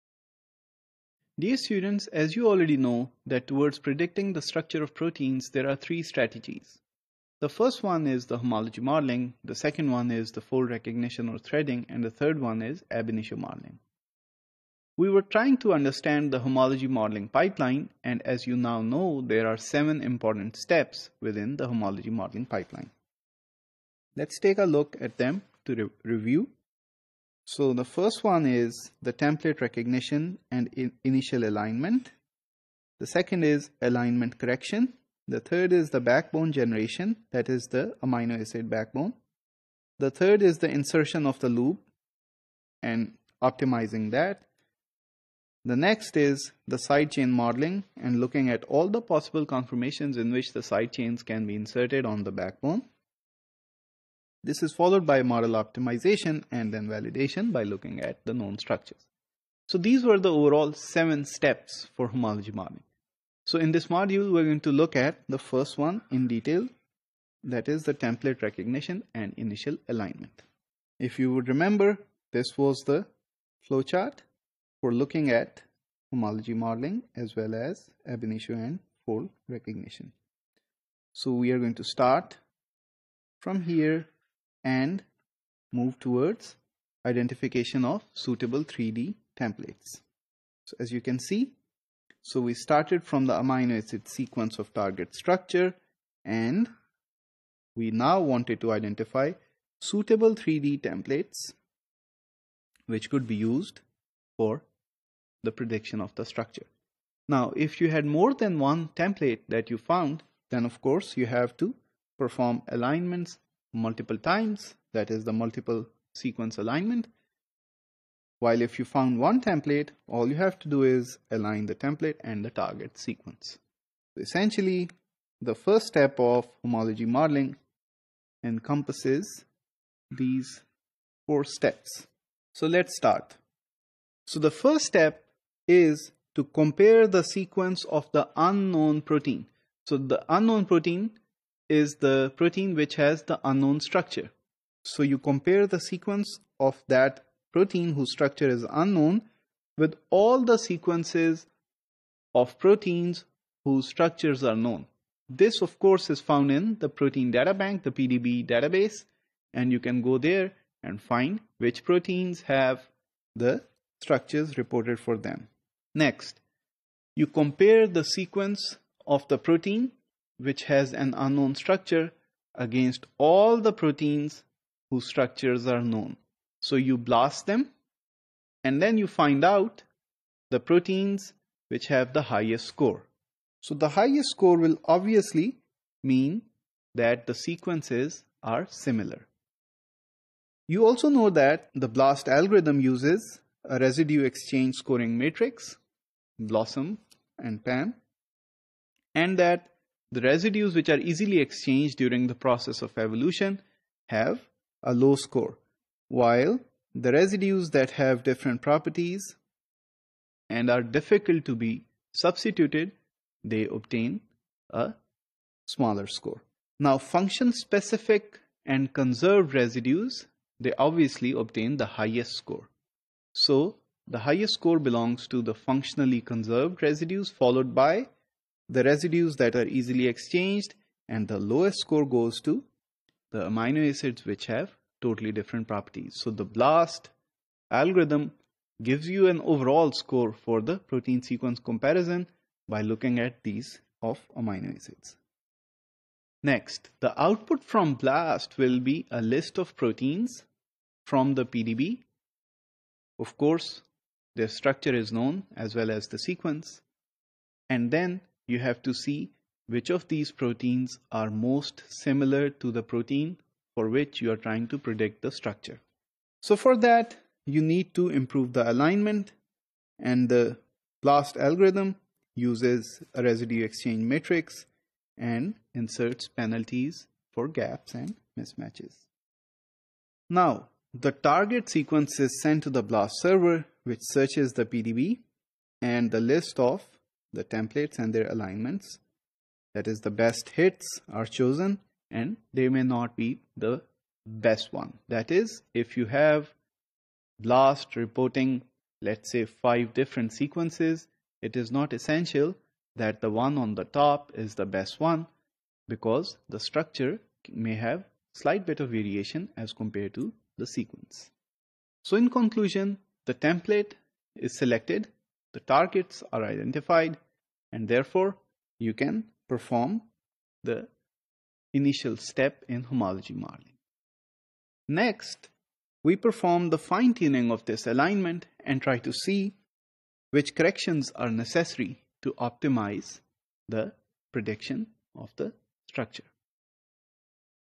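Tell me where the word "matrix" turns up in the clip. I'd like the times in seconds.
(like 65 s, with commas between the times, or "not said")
195 s, 274 s.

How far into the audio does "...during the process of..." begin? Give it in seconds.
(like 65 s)
201 s.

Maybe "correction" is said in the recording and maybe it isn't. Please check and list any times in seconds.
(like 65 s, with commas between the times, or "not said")
34 s, 330 s.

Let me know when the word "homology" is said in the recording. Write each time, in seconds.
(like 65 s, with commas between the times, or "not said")
8 s, 16 s, 21 s, 62 s, 76 s, 126 s, 322 s.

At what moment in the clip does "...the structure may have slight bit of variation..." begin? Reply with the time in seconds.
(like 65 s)
306 s.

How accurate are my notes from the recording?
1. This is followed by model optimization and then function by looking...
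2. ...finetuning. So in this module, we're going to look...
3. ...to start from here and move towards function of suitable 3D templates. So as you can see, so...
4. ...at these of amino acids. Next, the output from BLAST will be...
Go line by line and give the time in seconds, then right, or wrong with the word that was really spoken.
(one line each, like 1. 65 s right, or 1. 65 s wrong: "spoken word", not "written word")
1. 54 s wrong: "validation", not "function"
2. 62 s wrong: "modeling", not "finetuning"
3. 81 s wrong: "identification", not "function"
4. 243 s right.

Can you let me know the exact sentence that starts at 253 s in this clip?
Of course, their structure is known as well as the sequence.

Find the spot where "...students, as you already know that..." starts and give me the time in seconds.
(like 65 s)
1 s.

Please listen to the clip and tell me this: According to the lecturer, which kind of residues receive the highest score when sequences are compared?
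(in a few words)
functionally conserved residues.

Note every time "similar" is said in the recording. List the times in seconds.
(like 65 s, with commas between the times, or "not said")
188 s, 261 s.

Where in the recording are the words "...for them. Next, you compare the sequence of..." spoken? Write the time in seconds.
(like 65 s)
164 s.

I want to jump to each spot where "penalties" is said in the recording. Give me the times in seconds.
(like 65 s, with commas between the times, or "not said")
276 s.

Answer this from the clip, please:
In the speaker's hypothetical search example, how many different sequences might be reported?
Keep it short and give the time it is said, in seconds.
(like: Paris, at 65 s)
5, at 299 s.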